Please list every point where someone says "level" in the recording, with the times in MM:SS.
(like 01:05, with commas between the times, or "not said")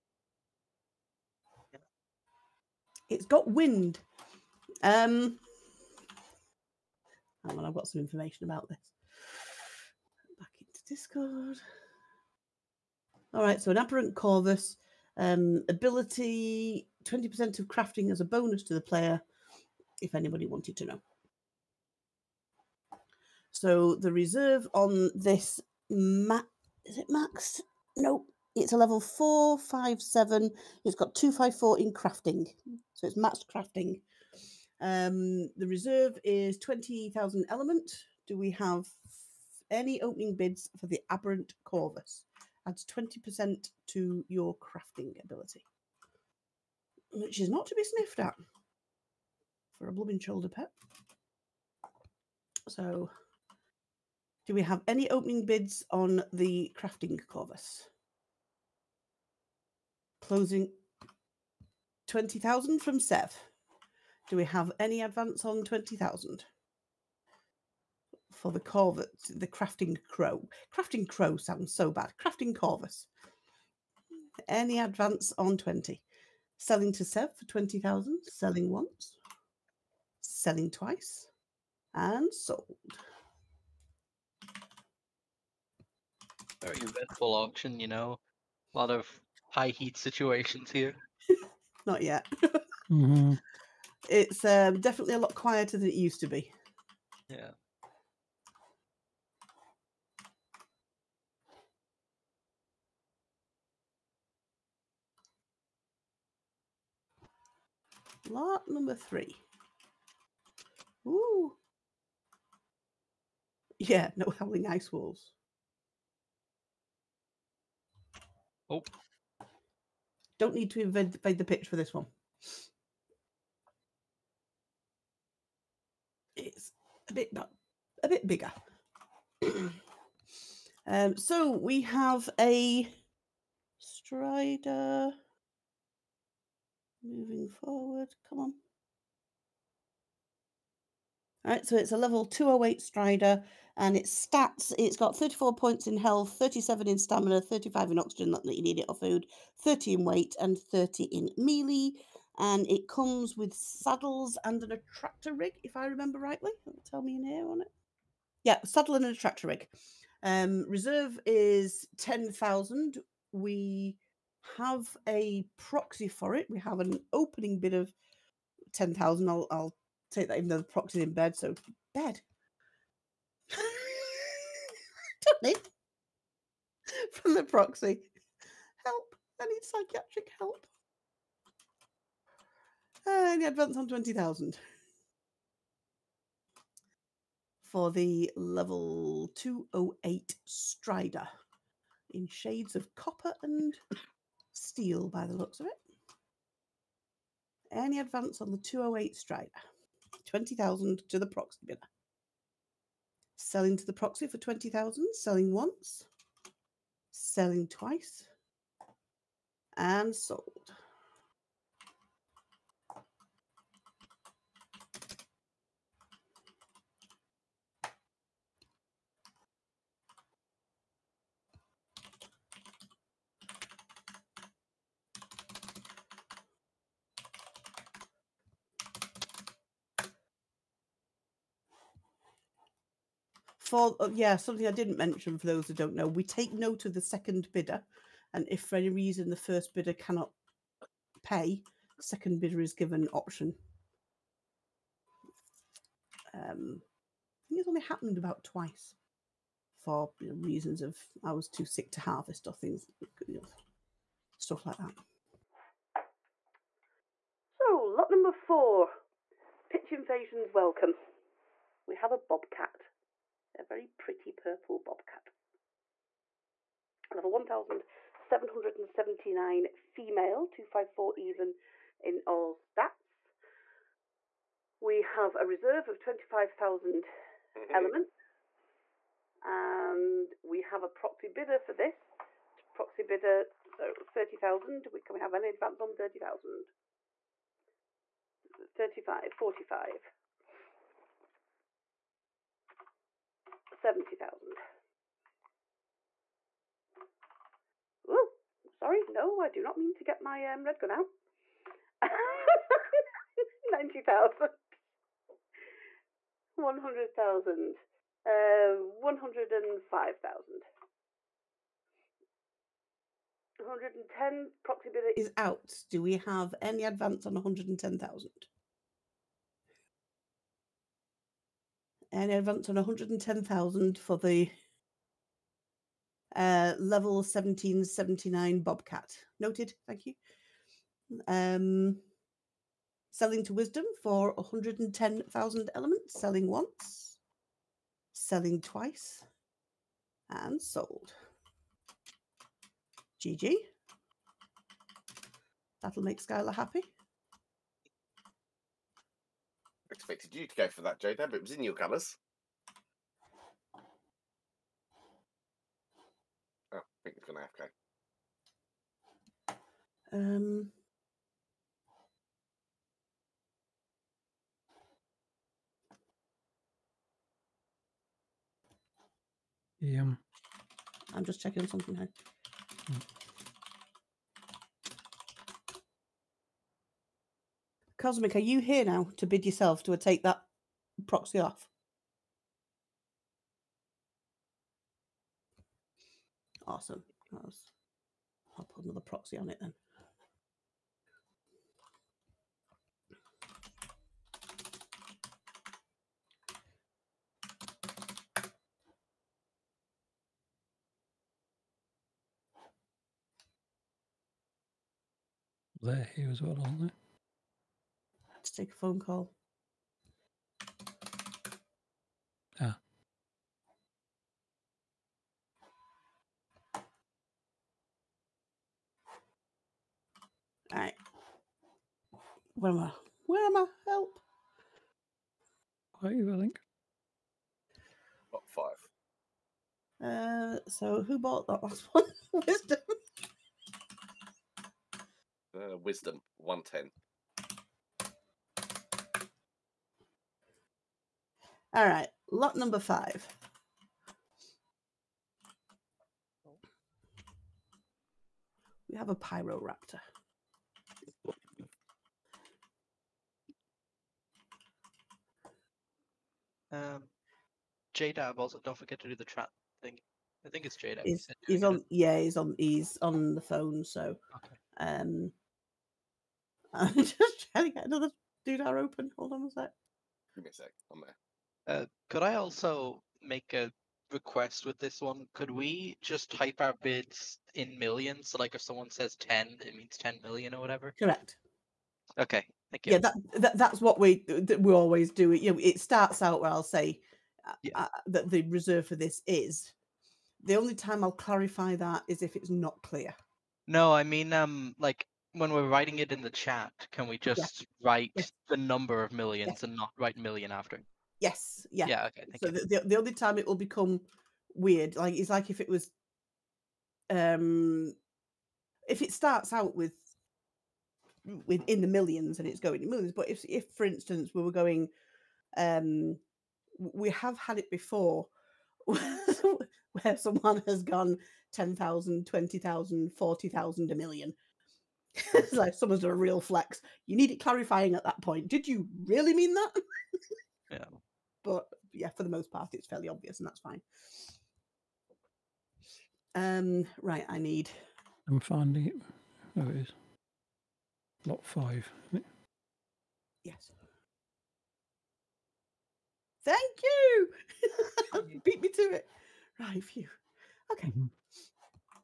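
00:28, 02:21, 03:08, 04:27, 05:26.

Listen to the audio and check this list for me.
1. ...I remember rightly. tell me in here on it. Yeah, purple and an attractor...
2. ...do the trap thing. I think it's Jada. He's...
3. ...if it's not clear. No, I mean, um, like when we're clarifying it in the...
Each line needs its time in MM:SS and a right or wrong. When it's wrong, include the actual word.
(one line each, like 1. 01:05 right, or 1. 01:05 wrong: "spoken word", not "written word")
1. 02:35 wrong: "saddle", not "purple"
2. 07:39 right
3. 08:12 wrong: "writing", not "clarifying".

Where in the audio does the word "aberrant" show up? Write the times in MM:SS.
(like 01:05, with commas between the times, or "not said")
00:13, 00:41.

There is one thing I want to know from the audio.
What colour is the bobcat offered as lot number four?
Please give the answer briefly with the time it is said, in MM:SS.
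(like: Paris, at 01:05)
purple, at 04:24.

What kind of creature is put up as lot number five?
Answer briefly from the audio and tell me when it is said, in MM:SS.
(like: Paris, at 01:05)
Pyroraptor, at 07:29.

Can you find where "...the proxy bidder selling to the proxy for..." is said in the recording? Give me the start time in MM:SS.
03:21.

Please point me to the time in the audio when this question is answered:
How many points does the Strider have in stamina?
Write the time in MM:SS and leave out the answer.
02:26.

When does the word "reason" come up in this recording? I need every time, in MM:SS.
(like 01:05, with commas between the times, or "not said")
03:58, 04:10.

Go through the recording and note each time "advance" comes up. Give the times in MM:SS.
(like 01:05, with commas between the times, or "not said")
01:05, 01:14, 03:03, 03:17, 04:45, 05:16, 05:22.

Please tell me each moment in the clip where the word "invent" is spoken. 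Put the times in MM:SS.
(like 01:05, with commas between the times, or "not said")
02:00.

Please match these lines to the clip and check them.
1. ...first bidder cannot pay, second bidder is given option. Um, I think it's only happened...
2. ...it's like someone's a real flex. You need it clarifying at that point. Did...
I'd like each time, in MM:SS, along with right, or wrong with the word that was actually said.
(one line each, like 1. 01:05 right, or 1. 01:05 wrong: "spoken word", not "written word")
1. 03:59 right
2. 08:45 right.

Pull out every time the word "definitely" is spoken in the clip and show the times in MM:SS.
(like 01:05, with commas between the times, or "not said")
01:34.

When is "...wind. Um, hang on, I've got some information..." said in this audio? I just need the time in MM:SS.
00:03.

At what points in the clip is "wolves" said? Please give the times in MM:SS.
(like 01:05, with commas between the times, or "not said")
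01:54.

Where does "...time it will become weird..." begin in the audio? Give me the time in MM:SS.
08:23.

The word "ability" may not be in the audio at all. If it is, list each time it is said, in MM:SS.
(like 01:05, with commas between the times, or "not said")
00:15, 00:45.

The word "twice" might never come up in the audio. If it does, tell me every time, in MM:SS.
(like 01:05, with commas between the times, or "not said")
01:20, 03:27, 04:08, 05:38.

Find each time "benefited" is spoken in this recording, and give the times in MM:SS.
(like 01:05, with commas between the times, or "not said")
not said.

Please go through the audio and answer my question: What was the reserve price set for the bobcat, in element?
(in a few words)
25,000.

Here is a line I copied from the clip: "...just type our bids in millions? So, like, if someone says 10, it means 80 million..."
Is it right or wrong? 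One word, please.
wrong.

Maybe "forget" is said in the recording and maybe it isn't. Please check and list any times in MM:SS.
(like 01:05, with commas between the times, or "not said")
07:38.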